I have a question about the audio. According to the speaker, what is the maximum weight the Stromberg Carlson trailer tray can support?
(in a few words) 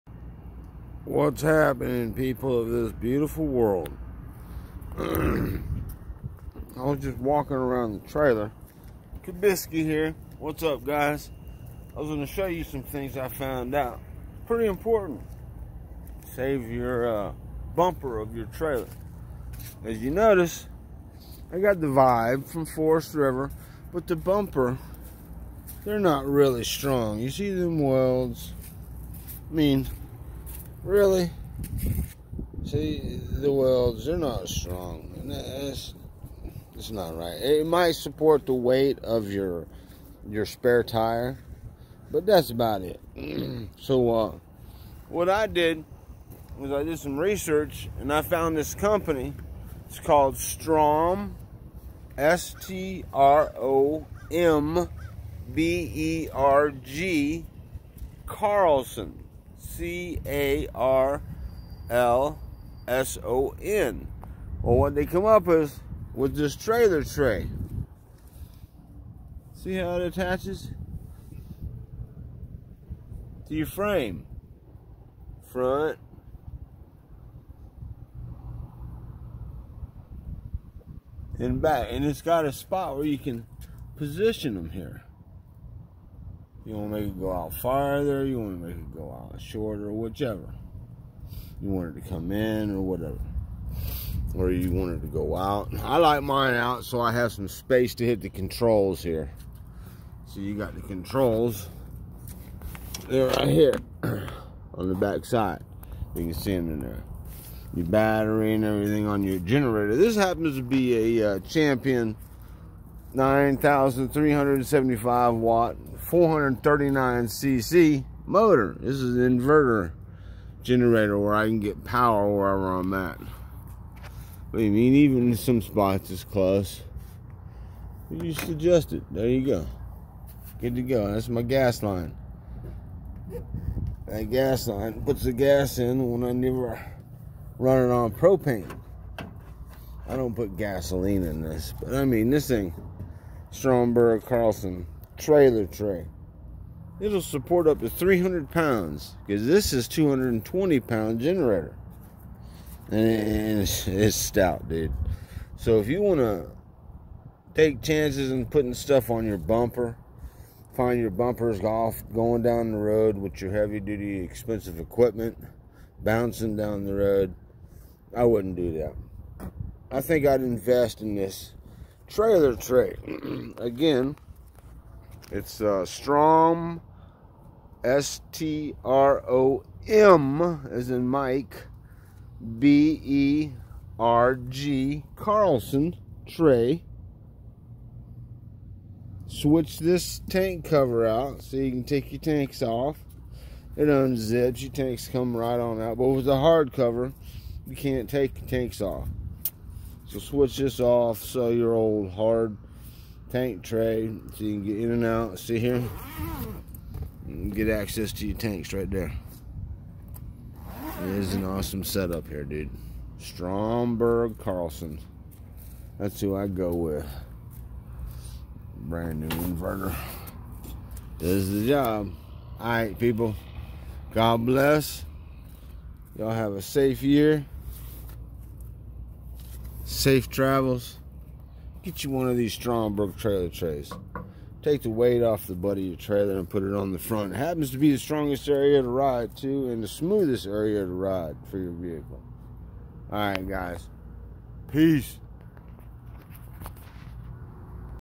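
300 pounds.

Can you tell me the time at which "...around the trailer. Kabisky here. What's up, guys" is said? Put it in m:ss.
0:07.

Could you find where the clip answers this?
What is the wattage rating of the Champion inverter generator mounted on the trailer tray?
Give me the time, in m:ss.
1:53.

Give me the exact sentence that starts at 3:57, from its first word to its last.
It happens to be the strongest area to ride too and the smoothest area to ride for your vehicle.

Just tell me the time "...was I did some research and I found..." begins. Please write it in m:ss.
0:46.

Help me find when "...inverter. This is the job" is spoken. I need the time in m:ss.
3:39.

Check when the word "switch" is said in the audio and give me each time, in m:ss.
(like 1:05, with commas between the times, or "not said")
3:09, 3:20.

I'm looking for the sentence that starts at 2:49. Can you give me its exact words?
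I think I'd invest in this trailer tray.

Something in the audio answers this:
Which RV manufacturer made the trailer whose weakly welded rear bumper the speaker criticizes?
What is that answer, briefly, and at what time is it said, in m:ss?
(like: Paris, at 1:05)
Forest River, at 0:22.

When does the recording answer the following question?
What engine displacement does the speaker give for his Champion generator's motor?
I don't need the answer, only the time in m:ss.
1:56.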